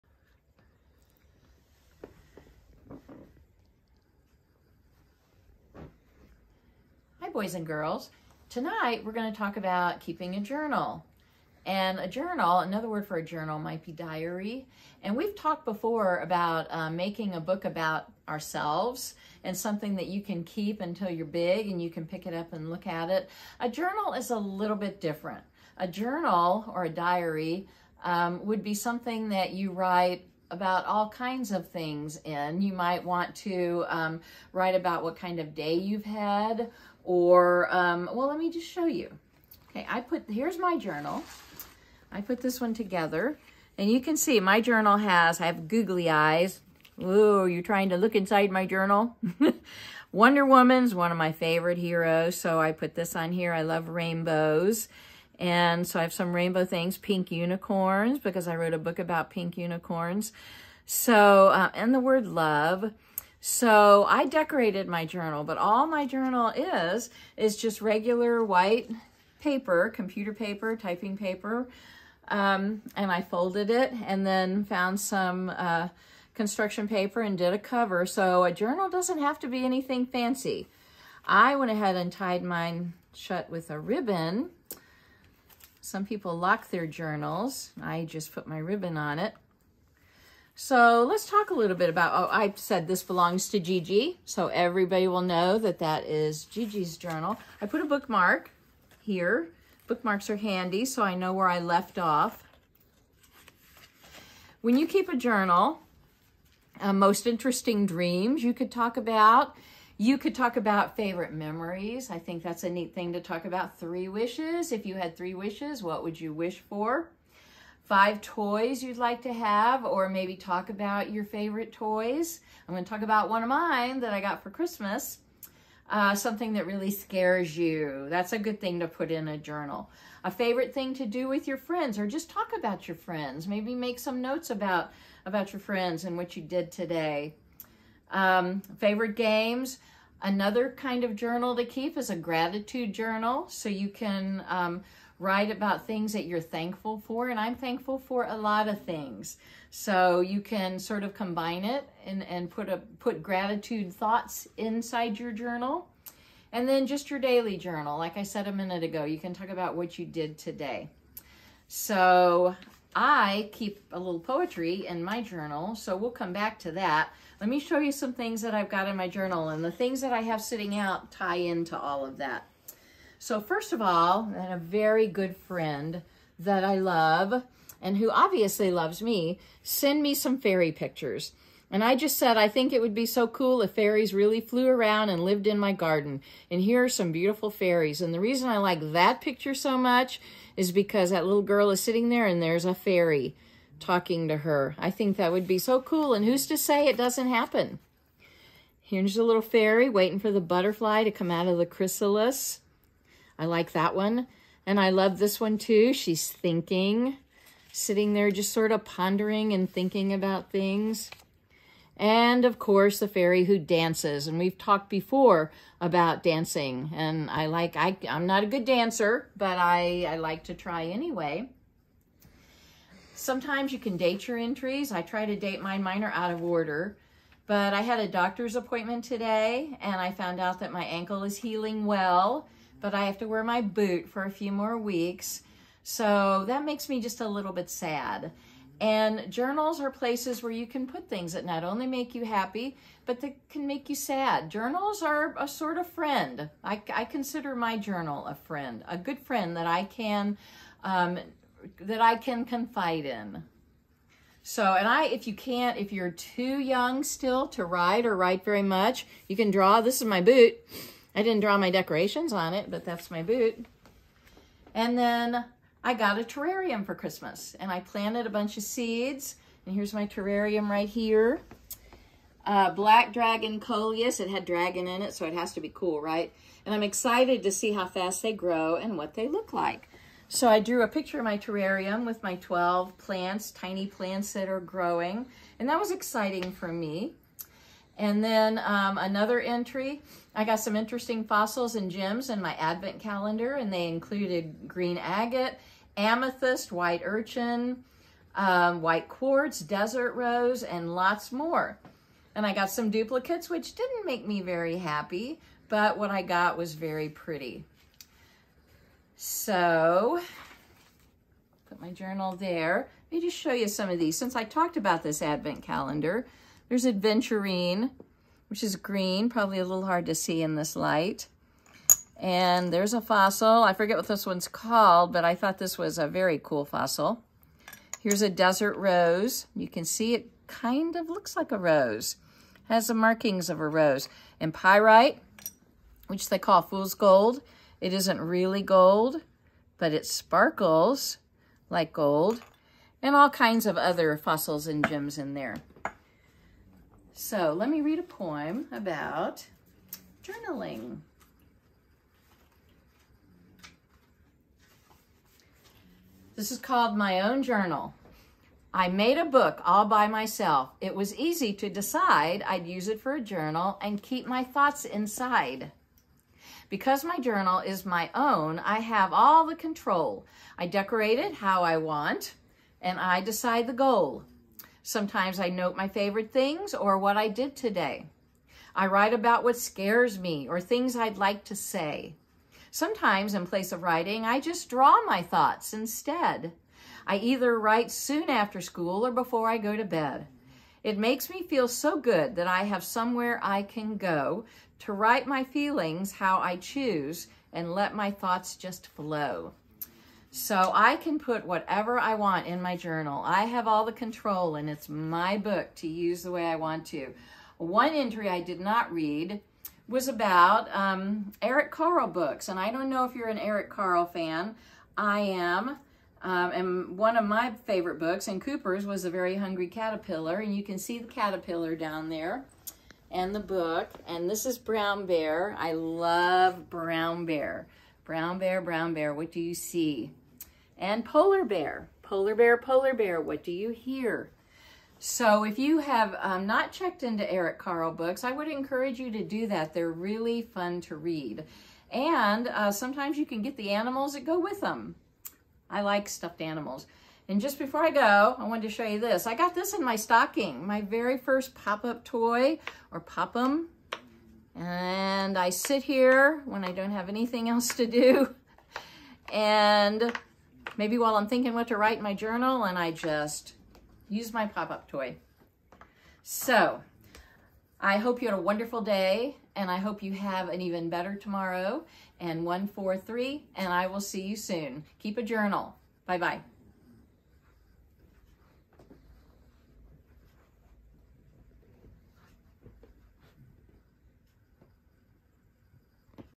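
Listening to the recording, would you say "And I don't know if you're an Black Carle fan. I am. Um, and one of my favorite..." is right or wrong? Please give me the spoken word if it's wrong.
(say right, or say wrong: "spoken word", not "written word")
wrong: "Eric", not "Black".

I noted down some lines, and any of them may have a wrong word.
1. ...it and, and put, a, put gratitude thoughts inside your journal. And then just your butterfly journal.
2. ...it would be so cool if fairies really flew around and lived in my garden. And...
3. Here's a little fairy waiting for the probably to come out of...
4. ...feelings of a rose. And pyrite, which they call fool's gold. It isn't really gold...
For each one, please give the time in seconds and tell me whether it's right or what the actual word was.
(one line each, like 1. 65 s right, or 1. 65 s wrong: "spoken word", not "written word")
1. 151 s wrong: "daily", not "butterfly"
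2. 182 s right
3. 198 s wrong: "butterfly", not "probably"
4. 332 s wrong: "markings", not "feelings".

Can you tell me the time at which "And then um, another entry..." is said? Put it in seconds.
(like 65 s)
287 s.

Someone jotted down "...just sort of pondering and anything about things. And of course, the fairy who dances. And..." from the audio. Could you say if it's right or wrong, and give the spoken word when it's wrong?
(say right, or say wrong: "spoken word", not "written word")
wrong: "thinking", not "anything".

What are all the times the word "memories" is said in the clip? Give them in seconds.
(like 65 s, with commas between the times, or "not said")
111 s.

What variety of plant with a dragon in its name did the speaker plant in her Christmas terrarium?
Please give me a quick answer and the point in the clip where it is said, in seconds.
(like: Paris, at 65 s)
Black Dragon Coleus, at 272 s.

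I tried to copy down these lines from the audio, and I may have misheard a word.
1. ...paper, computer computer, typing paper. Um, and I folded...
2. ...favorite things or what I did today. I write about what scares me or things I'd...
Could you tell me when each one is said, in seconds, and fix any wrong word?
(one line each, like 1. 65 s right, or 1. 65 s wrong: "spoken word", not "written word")
1. 69 s wrong: "paper", not "computer"
2. 375 s right.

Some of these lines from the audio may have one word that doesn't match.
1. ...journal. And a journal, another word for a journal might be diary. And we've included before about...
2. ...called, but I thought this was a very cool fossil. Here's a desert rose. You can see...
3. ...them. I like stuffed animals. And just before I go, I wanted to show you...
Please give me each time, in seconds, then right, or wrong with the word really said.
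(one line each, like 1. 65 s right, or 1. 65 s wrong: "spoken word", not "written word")
1. 10 s wrong: "talked", not "included"
2. 324 s right
3. 444 s right.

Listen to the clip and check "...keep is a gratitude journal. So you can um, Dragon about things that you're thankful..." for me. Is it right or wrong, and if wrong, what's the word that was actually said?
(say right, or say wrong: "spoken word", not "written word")
wrong: "Write", not "Dragon".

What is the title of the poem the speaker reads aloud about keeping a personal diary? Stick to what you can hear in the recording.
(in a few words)
My Own Journal.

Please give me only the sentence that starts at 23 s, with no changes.
A journal is a little bit different.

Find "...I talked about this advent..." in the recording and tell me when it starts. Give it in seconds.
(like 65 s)
314 s.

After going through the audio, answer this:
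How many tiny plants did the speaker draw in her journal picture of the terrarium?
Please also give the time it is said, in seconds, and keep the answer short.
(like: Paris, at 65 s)
12, at 282 s.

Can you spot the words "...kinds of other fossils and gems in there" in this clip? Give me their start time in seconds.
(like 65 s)
343 s.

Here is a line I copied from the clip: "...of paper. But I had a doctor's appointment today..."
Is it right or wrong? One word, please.
wrong.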